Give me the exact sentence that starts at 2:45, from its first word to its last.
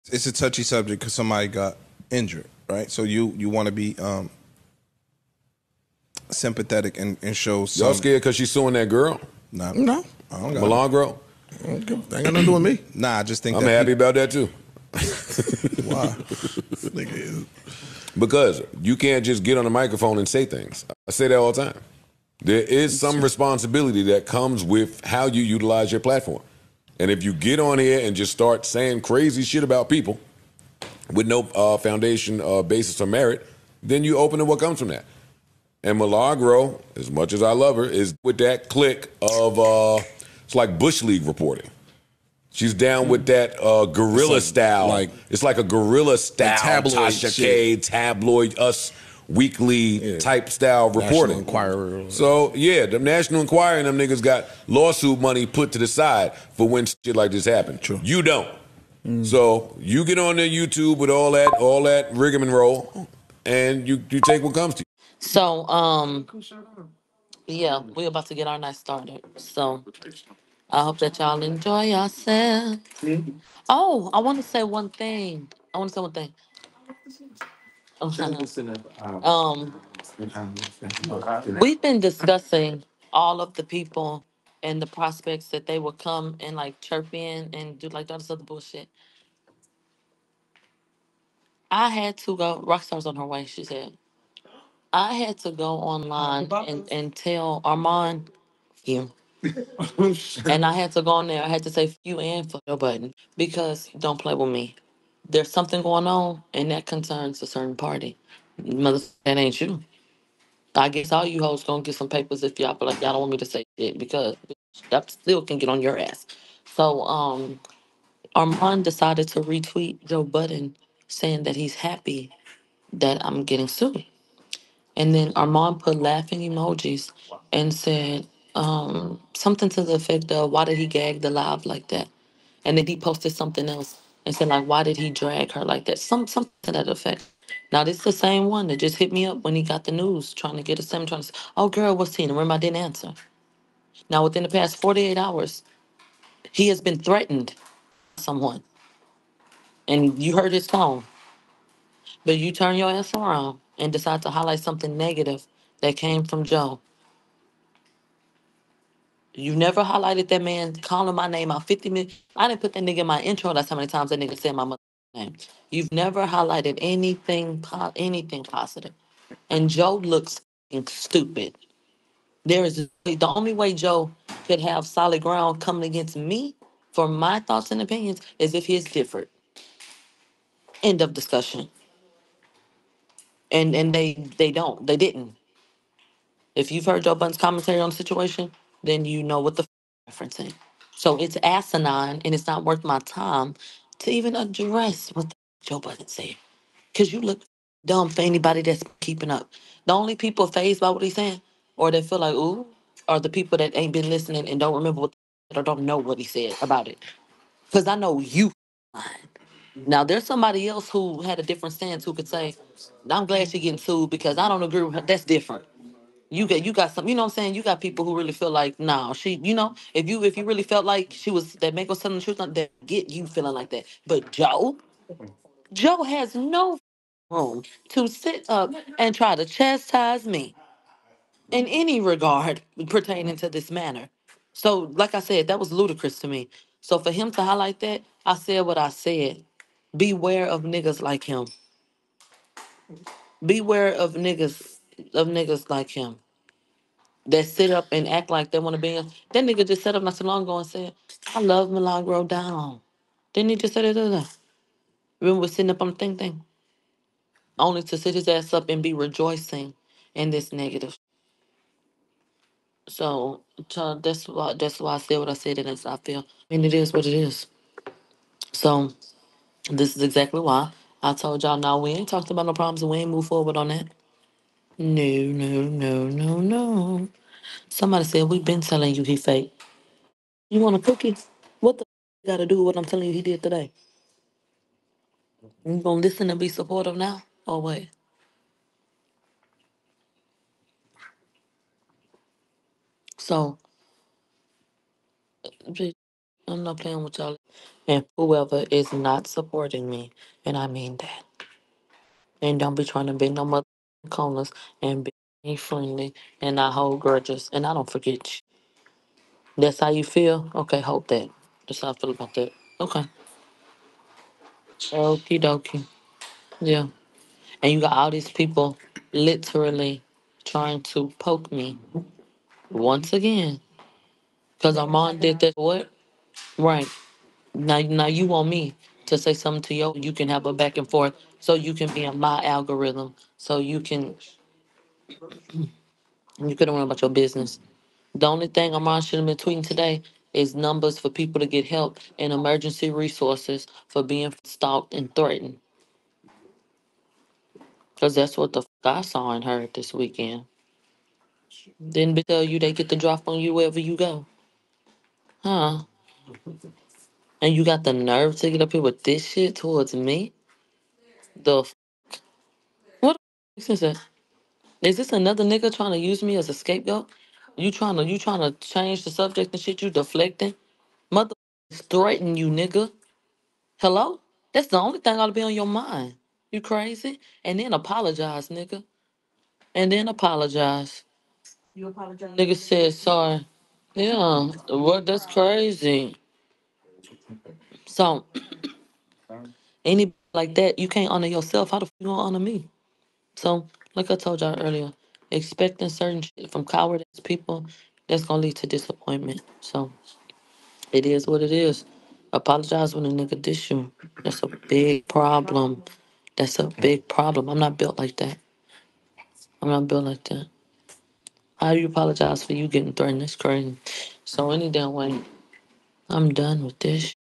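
You've never highlighted anything, po- anything positive.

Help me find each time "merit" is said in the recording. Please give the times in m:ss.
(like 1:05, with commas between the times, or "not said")
0:33.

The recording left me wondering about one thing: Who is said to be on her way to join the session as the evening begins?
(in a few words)
Rockstar.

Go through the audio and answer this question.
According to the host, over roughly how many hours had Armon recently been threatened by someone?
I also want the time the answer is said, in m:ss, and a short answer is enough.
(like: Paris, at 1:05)
48, at 2:24.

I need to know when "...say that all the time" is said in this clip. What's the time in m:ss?
0:21.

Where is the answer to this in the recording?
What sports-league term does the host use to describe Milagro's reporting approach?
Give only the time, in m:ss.
0:40.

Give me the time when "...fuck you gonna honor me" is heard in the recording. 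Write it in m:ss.
6:31.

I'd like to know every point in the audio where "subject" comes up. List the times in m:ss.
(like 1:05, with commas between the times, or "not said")
0:00, 6:09.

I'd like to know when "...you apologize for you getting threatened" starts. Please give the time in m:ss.
6:51.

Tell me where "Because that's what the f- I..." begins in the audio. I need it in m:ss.
5:47.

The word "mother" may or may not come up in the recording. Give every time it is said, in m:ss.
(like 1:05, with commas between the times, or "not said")
1:48, 2:44, 5:03, 6:11.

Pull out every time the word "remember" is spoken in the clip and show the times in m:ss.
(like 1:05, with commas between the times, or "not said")
2:22, 3:24, 4:15.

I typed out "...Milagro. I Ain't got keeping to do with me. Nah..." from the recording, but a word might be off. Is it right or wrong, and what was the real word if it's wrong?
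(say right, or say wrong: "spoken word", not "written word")
wrong: "nothing", not "keeping".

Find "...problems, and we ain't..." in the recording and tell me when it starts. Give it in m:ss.
4:32.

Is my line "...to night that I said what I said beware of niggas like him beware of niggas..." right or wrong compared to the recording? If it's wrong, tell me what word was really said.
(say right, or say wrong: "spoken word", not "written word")
wrong: "highlight", not "night".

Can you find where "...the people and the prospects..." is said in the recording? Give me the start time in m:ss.
1:23.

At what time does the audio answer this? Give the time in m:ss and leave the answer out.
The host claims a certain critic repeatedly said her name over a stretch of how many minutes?
2:41.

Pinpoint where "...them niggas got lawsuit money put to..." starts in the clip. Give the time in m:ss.
0:53.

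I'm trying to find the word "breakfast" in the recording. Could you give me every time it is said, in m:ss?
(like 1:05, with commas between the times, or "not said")
not said.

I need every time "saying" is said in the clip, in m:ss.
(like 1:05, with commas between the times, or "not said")
0:28, 2:01, 3:21, 3:37.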